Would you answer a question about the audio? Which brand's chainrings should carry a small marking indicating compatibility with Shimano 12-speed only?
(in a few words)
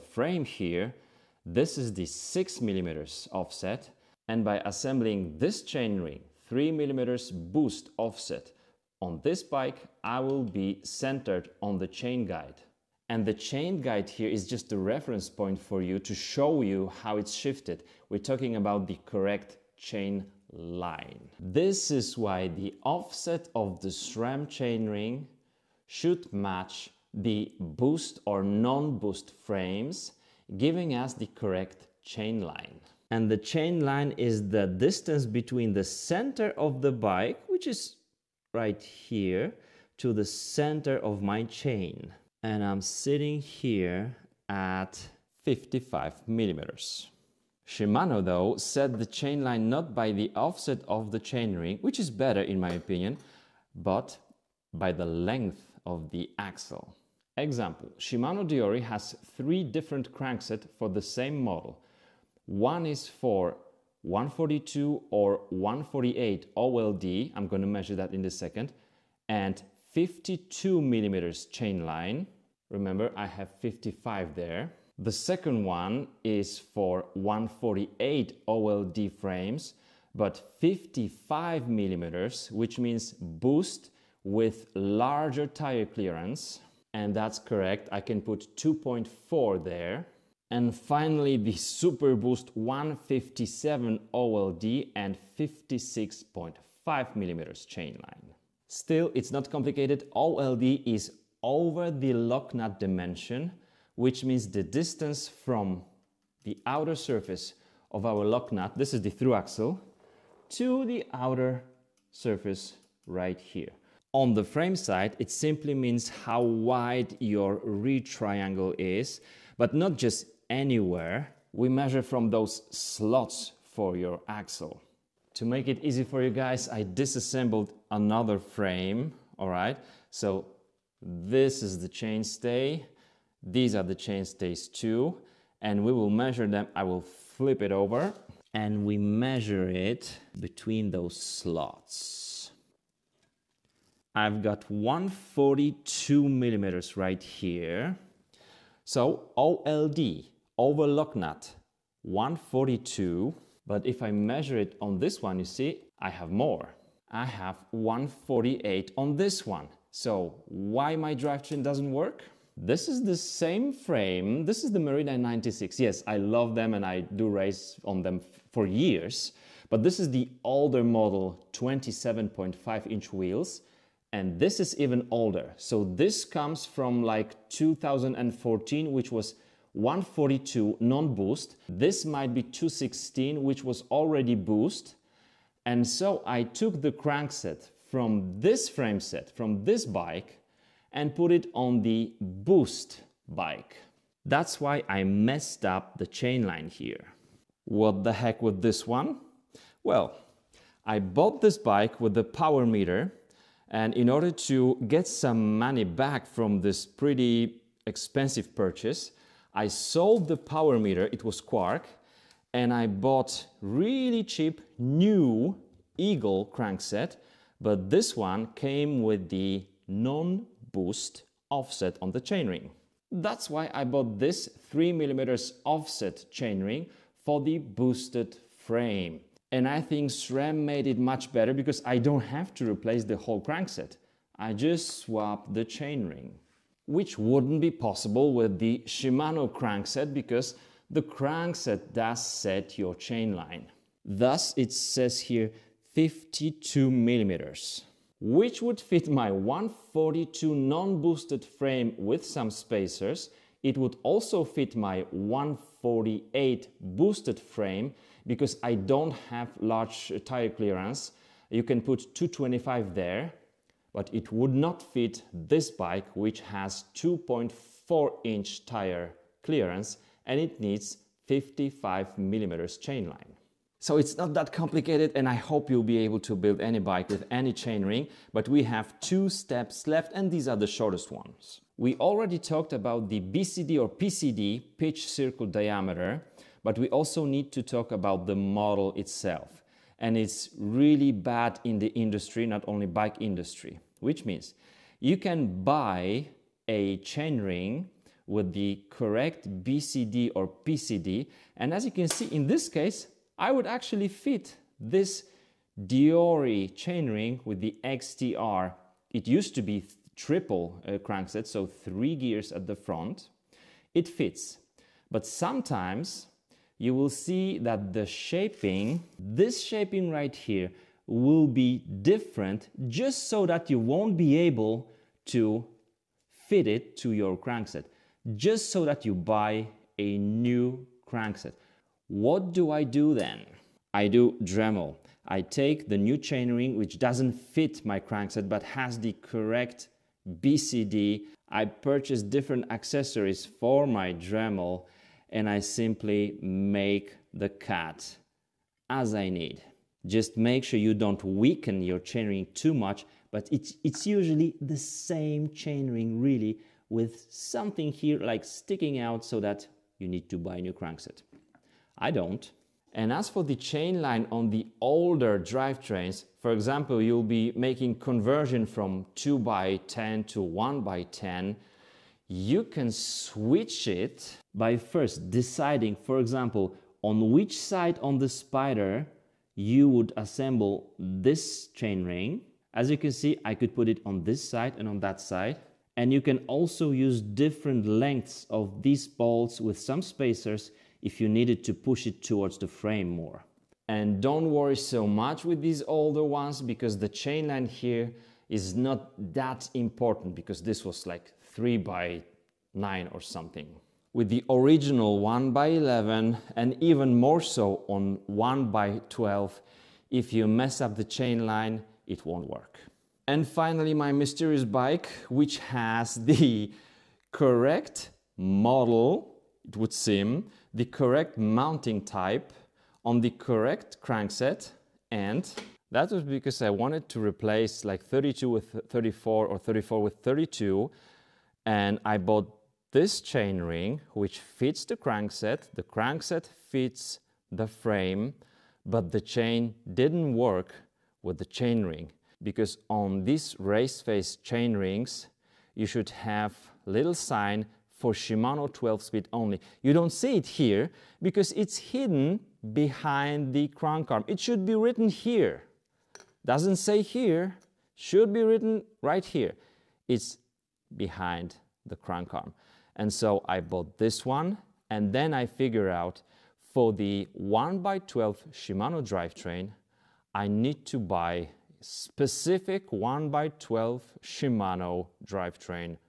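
Race Face.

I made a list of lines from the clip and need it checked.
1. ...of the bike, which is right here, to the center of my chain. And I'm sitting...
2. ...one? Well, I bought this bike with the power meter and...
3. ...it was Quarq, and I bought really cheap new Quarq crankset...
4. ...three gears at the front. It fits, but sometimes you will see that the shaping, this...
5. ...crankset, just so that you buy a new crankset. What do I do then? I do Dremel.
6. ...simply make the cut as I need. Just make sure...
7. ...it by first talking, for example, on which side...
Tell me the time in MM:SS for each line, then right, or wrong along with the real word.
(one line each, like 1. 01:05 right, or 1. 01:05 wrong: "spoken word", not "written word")
1. 00:36 right
2. 03:18 right
3. 03:31 wrong: "Eagle", not "Quarq"
4. 05:11 right
5. 05:27 right
6. 05:45 right
7. 06:13 wrong: "deciding", not "talking".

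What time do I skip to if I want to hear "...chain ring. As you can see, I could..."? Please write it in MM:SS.
06:21.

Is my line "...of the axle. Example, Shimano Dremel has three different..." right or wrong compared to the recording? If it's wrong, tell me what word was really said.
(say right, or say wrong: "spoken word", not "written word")
wrong: "Deore", not "Dremel".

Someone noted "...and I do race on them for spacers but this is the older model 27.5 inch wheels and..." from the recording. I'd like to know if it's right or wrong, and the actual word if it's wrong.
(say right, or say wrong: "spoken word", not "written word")
wrong: "years", not "spacers".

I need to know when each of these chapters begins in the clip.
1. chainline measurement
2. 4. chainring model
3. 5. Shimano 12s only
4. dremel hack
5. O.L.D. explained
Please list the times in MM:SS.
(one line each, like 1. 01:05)
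1. 00:35
2. 04:42
3. 06:55
4. 05:16
5. 01:40.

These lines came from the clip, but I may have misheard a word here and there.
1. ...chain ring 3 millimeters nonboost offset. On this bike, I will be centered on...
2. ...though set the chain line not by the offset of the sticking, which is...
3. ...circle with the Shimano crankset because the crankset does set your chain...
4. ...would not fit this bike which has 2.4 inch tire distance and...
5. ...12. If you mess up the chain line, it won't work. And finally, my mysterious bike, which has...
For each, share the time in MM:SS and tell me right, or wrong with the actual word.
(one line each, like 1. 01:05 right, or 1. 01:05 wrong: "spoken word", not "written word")
1. 00:05 wrong: "boost", not "nonboost"
2. 00:48 wrong: "chainring", not "sticking"
3. 03:57 wrong: "possible", not "circle"
4. 04:24 wrong: "clearance", not "distance"
5. 06:49 right.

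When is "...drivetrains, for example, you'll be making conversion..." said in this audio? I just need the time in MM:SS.
06:05.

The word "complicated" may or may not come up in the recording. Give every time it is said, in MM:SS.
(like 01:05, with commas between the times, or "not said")
01:39, 04:34.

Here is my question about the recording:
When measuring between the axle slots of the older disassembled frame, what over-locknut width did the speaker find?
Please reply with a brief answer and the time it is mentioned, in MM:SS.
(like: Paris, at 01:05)
142 millimeters, at 02:24.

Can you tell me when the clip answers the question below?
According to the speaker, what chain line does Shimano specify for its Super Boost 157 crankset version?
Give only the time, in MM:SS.
01:35.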